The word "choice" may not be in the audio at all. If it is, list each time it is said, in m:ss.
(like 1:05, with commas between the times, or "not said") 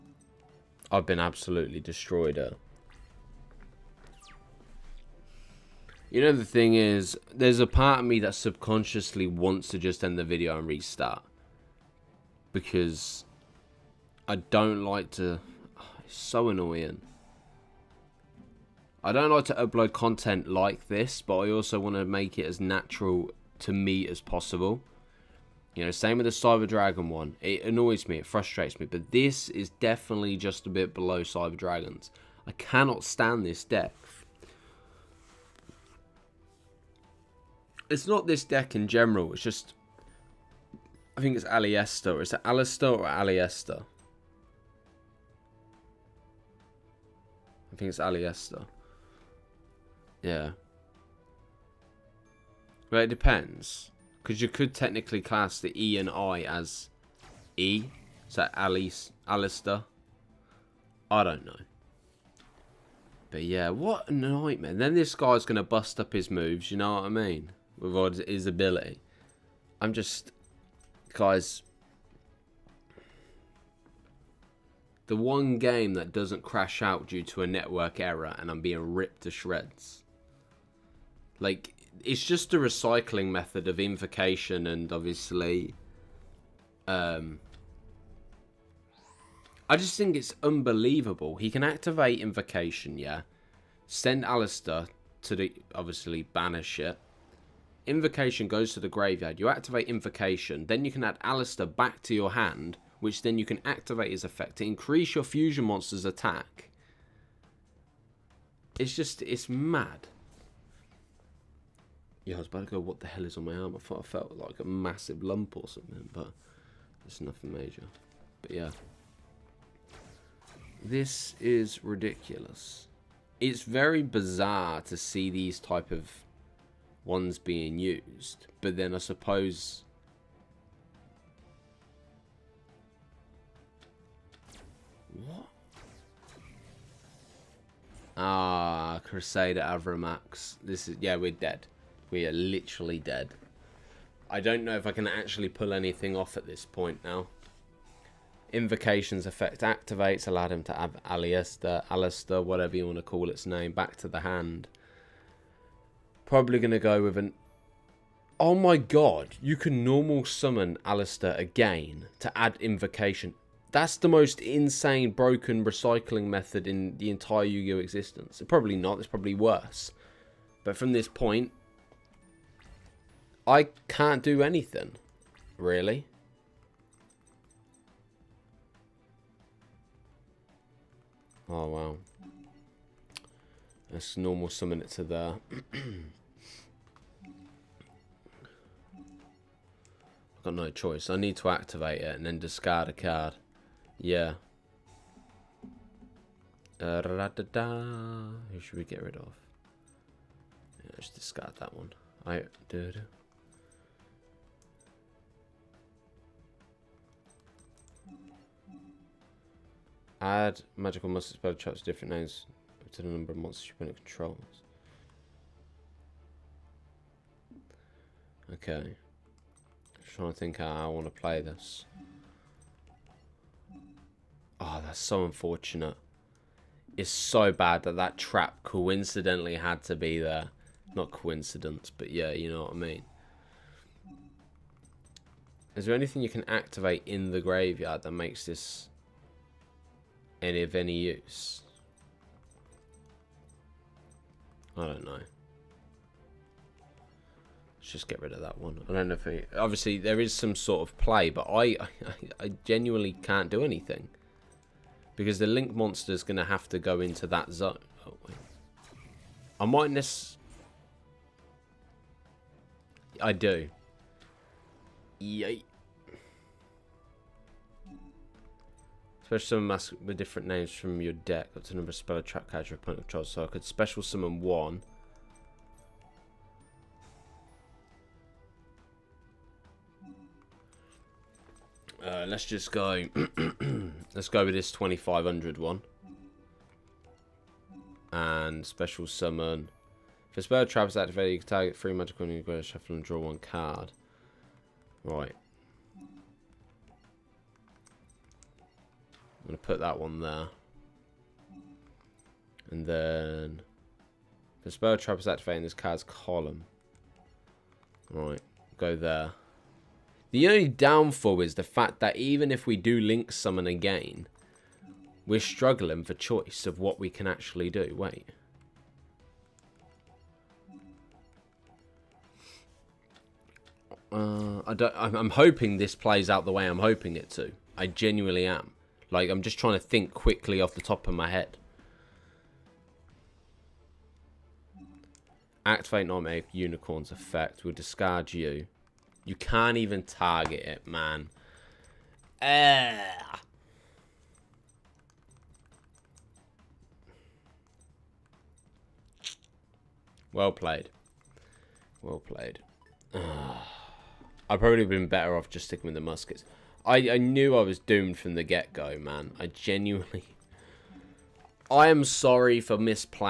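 3:10, 5:16.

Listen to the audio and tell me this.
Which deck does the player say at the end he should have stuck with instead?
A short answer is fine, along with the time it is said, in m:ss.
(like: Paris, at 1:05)
the muskets, at 5:55.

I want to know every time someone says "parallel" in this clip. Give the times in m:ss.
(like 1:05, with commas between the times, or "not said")
not said.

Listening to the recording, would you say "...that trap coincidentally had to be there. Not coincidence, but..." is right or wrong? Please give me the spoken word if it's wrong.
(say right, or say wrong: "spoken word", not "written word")
right.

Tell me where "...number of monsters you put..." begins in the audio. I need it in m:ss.
3:33.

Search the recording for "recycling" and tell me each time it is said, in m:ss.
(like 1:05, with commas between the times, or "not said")
1:22, 2:45.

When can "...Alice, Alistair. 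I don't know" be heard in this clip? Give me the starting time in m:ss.
0:58.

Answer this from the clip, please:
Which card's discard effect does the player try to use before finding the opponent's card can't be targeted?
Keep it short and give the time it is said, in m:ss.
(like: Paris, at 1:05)
Nightmare Unicorn, at 5:36.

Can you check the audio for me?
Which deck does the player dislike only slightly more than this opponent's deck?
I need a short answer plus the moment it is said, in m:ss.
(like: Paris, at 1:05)
Cyber Dragons, at 0:31.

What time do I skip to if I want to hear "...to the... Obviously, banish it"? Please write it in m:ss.
1:35.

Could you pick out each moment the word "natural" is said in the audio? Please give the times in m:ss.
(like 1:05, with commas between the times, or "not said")
0:22.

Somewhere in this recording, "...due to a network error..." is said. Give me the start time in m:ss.
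1:17.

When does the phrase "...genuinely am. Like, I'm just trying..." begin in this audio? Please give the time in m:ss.
5:27.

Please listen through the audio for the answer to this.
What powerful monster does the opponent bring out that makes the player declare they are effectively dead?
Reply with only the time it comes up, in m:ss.
2:19.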